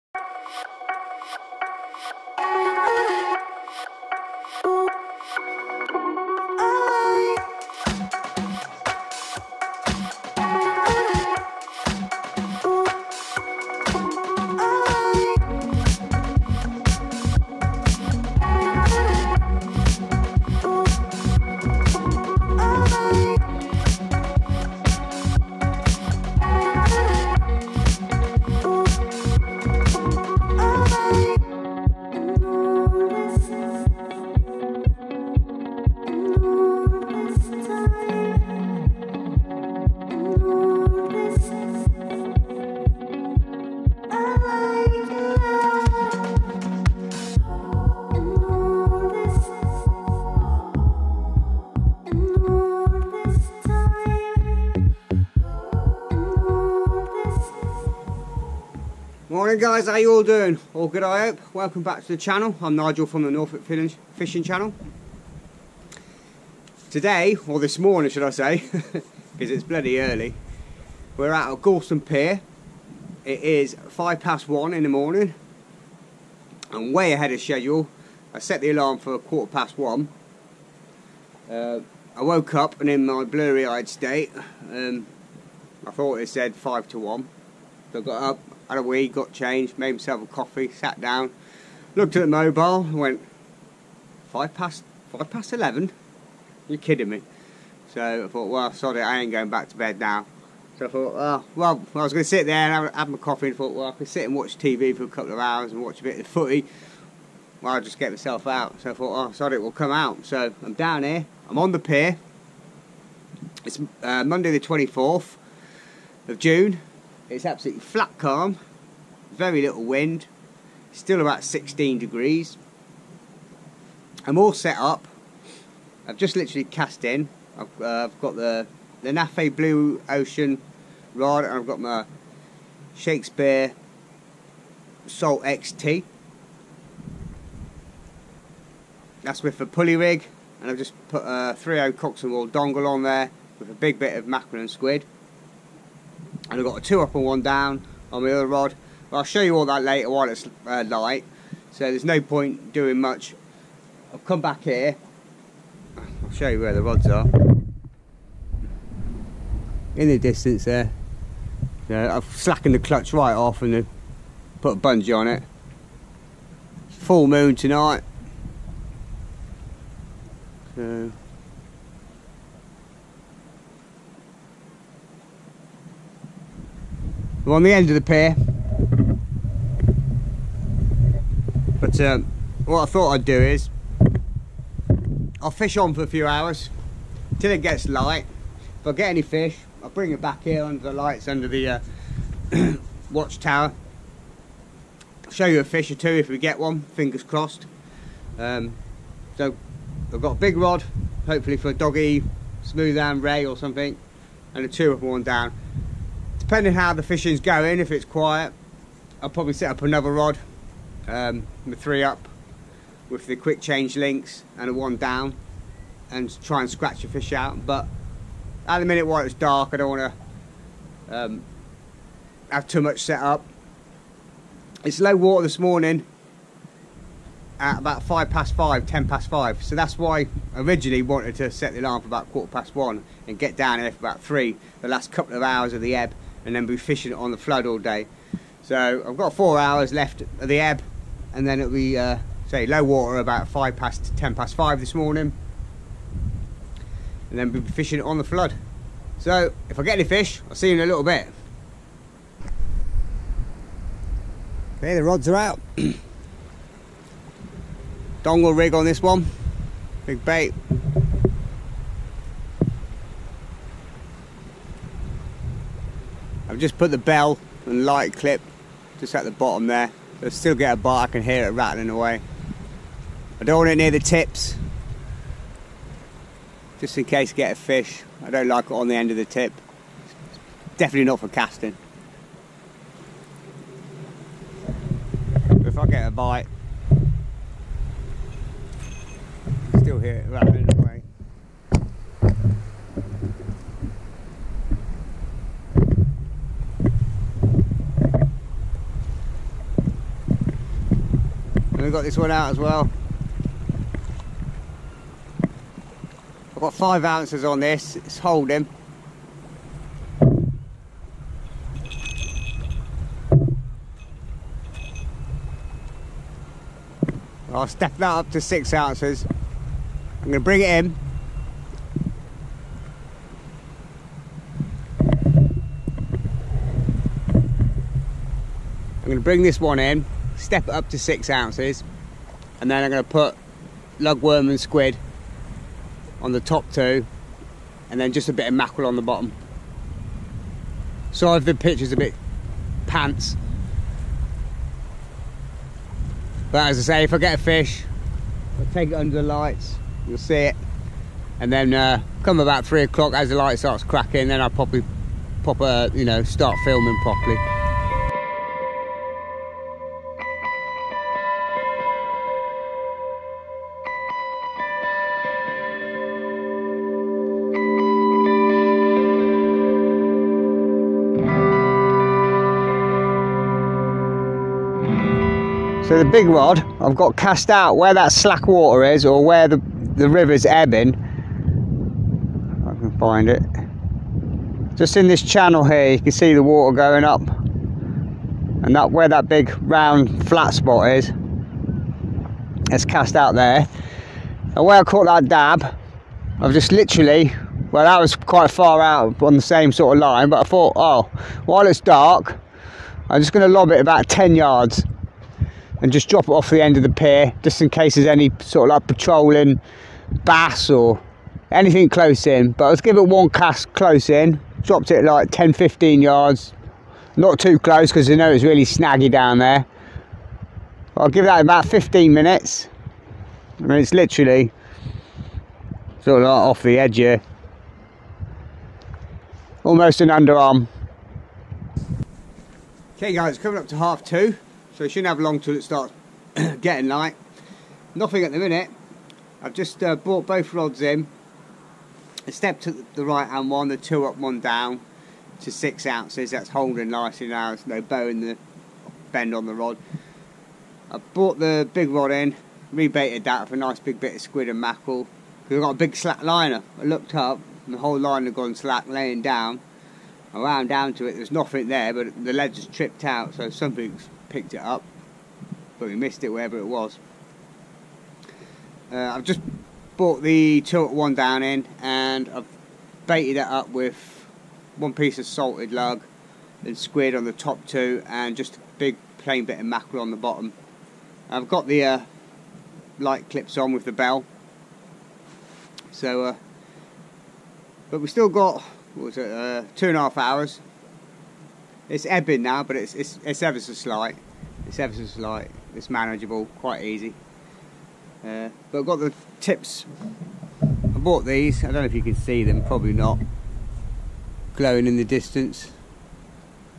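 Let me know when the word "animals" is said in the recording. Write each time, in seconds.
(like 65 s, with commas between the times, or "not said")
not said.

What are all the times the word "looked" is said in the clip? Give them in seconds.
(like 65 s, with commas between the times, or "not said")
91 s, 456 s.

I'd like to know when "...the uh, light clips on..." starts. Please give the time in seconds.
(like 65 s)
481 s.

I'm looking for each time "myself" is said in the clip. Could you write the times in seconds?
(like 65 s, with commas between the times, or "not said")
89 s, 108 s.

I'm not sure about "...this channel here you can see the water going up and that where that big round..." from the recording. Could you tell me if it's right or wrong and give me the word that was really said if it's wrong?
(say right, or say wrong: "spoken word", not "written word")
right.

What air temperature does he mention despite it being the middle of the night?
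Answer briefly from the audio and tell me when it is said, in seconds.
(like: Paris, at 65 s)
16 degrees, at 121 s.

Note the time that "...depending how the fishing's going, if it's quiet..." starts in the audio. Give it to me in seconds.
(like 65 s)
206 s.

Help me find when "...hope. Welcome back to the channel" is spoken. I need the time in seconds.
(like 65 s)
61 s.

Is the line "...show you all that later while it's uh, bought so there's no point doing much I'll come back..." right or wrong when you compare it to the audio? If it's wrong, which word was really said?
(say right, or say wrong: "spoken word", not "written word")
wrong: "light", not "bought".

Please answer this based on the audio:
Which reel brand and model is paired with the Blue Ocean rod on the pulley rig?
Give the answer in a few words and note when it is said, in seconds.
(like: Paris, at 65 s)
Shakespeare Salt XT, at 132 s.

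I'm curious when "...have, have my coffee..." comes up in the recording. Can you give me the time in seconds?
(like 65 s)
102 s.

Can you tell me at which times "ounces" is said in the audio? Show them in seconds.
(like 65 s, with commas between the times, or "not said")
307 s, 318 s, 331 s, 445 s.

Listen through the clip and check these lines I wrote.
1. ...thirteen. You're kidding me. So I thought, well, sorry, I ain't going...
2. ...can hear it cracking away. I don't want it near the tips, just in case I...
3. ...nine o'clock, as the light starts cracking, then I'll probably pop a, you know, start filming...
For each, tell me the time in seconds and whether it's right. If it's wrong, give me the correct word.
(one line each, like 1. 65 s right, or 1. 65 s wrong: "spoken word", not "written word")
1. 95 s wrong: "eleven", not "thirteen"
2. 271 s wrong: "rattling", not "cracking"
3. 352 s wrong: "three", not "nine".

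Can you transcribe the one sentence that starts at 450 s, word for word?
I brought the big rod in, rebaited that with a nice big bit of squid and mackerel.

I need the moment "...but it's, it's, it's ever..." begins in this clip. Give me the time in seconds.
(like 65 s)
492 s.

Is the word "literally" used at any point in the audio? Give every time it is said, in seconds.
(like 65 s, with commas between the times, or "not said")
126 s, 396 s, 423 s.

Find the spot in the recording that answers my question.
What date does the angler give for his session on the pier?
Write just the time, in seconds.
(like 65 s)
114 s.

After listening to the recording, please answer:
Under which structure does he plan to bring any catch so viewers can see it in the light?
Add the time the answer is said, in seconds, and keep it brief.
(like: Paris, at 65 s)
watchtower, at 193 s.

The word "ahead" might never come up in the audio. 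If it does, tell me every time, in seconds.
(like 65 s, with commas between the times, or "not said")
77 s.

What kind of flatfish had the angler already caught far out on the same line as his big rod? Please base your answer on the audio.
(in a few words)
dab.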